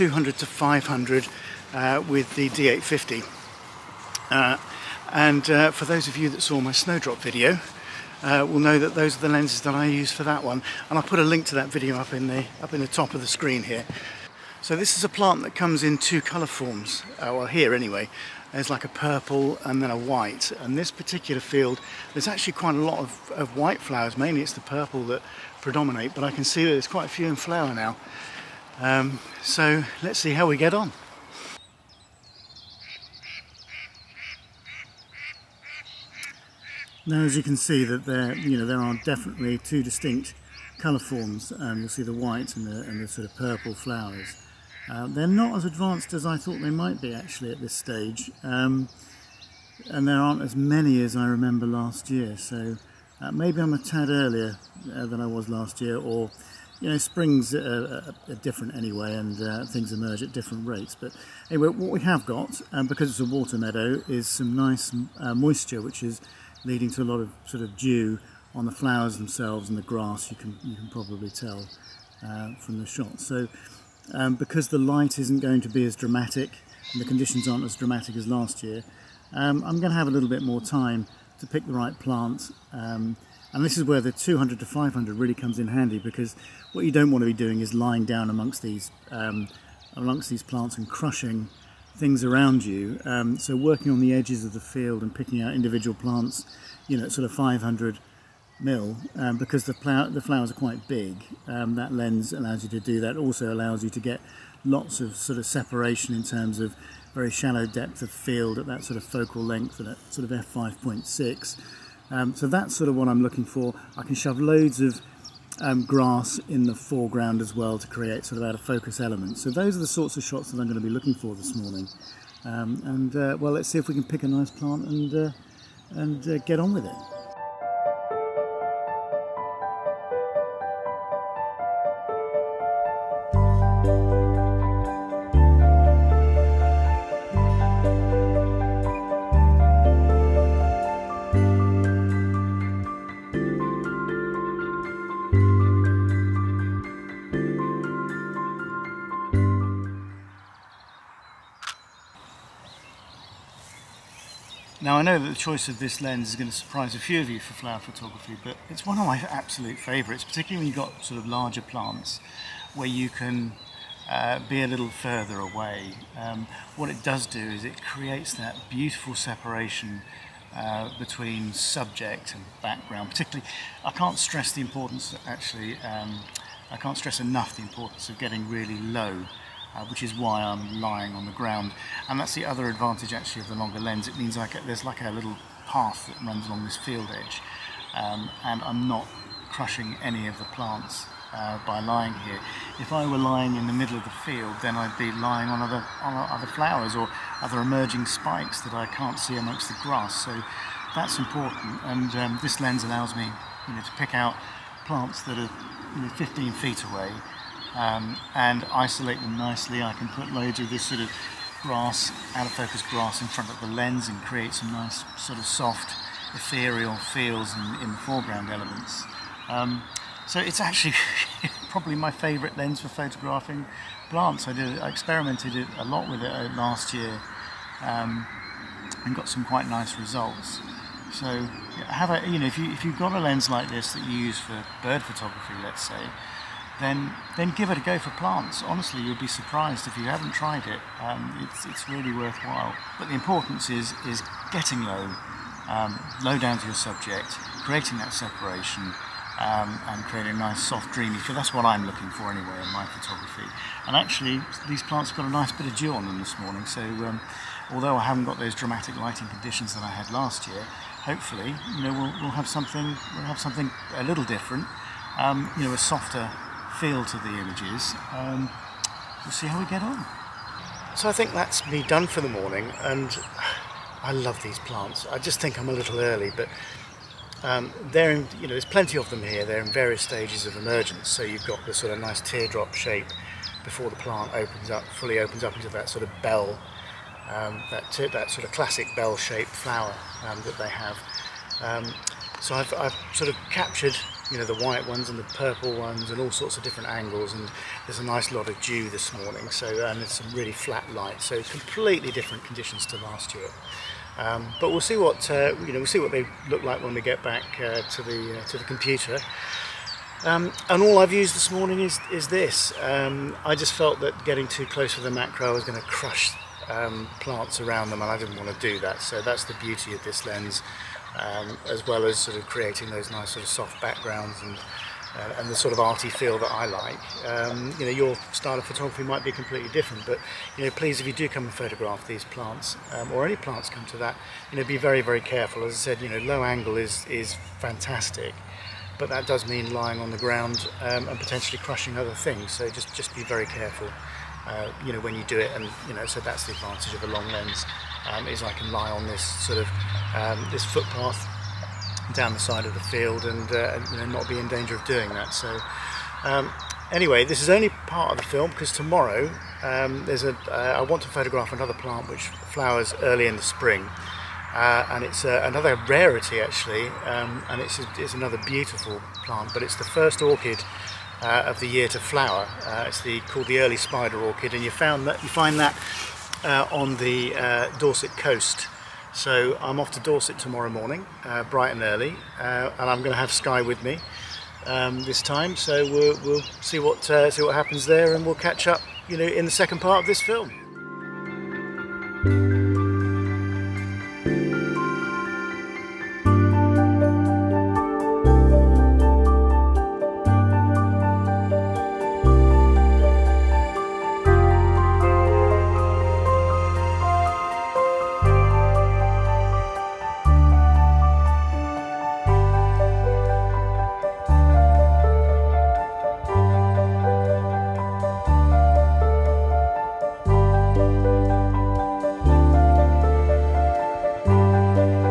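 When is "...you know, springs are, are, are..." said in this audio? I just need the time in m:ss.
0:56.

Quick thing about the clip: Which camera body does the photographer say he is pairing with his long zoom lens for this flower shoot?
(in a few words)
D850.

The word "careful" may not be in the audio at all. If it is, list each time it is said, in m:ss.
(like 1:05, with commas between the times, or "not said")
5:35, 5:43.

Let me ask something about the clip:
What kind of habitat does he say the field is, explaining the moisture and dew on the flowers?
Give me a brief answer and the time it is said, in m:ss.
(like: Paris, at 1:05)
Water meadow, at 1:03.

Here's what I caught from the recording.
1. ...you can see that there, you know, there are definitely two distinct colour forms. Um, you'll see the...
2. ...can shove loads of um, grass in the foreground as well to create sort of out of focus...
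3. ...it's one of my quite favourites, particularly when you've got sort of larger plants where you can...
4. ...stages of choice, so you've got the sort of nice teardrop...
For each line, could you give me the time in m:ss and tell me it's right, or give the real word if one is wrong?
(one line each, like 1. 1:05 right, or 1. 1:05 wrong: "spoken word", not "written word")
1. 0:37 right
2. 1:54 right
3. 2:38 wrong: "absolute", not "quite"
4. 4:40 wrong: "emergence", not "choice".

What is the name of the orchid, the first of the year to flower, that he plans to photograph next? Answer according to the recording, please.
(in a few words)
Early spider orchid.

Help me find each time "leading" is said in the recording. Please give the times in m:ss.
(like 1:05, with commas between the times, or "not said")
1:06.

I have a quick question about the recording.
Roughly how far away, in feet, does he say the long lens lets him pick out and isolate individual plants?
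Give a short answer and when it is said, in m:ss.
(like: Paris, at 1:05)
15 feet, at 3:26.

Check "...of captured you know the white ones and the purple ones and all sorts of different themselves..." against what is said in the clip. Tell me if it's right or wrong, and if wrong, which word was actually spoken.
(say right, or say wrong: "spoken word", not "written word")
wrong: "angles", not "themselves".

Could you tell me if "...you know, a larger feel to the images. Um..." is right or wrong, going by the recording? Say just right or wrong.
wrong.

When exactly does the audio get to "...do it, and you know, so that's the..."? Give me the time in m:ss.
5:45.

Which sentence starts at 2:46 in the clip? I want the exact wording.
Um, what it does do is it creates that beautiful separation uh, between subject and background.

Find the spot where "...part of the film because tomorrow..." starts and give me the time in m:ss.
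5:57.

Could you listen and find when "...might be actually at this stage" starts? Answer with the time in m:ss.
0:46.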